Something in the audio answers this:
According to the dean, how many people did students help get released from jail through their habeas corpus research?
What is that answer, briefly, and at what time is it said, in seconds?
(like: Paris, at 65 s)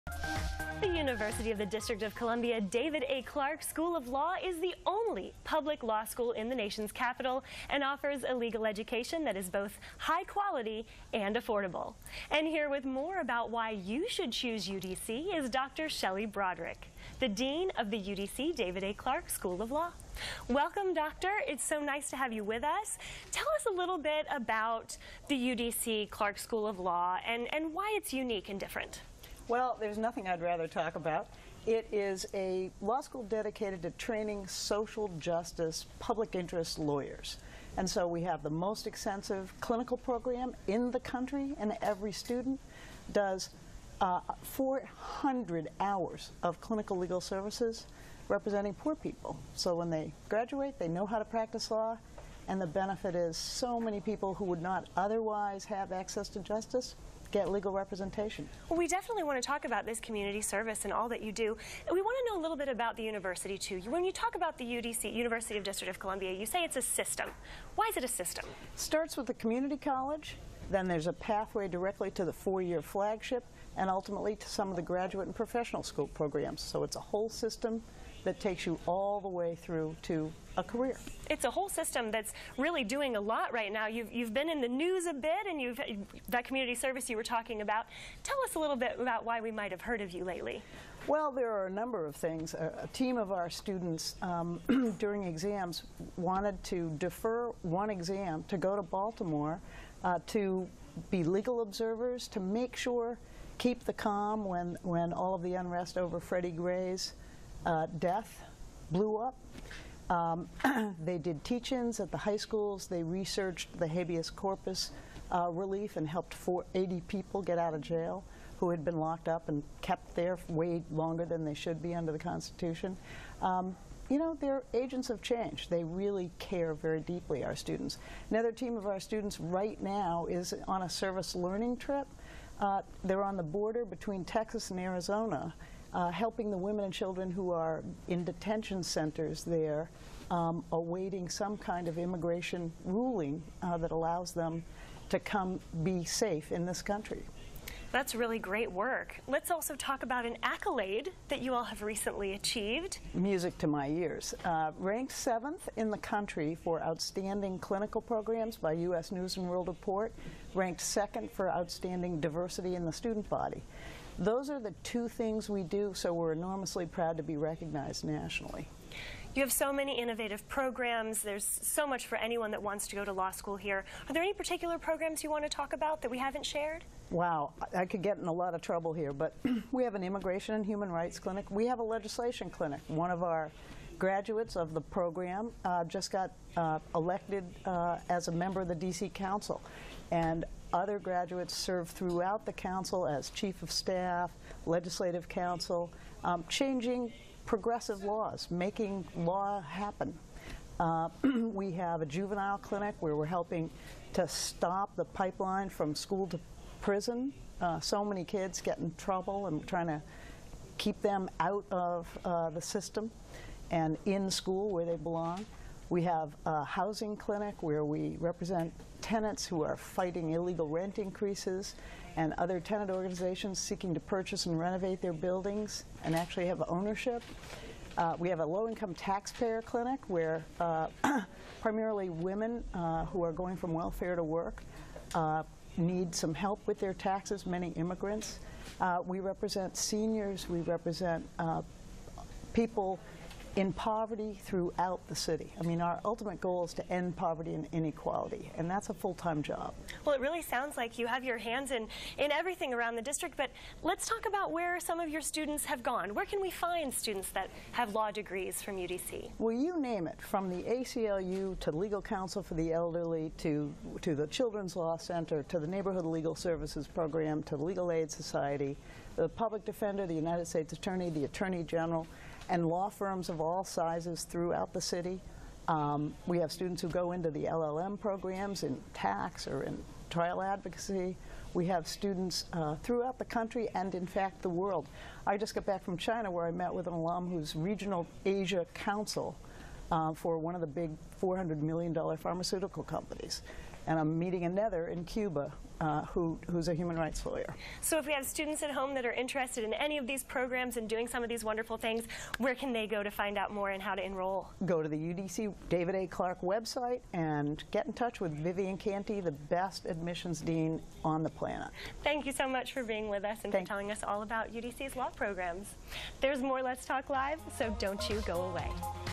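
80, at 116 s.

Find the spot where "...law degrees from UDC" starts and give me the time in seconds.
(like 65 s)
257 s.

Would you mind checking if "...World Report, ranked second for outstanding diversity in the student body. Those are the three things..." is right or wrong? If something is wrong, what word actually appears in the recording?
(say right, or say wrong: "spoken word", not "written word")
wrong: "two", not "three".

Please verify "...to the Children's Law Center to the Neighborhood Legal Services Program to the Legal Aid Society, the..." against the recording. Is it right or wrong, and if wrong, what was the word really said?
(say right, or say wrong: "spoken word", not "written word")
right.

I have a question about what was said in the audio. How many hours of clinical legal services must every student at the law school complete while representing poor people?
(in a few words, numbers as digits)
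400.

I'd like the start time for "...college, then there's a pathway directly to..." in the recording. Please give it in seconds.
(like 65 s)
69 s.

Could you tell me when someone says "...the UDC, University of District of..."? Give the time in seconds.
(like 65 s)
64 s.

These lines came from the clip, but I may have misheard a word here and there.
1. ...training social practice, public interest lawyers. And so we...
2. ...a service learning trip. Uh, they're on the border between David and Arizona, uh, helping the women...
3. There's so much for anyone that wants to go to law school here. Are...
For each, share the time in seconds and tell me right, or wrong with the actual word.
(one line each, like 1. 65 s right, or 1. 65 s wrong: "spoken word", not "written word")
1. 33 s wrong: "justice", not "practice"
2. 130 s wrong: "Texas", not "David"
3. 171 s right.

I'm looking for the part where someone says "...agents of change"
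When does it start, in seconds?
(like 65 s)
124 s.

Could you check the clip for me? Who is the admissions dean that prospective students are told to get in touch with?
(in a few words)
Vivian Canty.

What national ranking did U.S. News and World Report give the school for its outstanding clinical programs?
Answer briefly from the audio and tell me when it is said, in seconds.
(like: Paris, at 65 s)
7th, at 155 s.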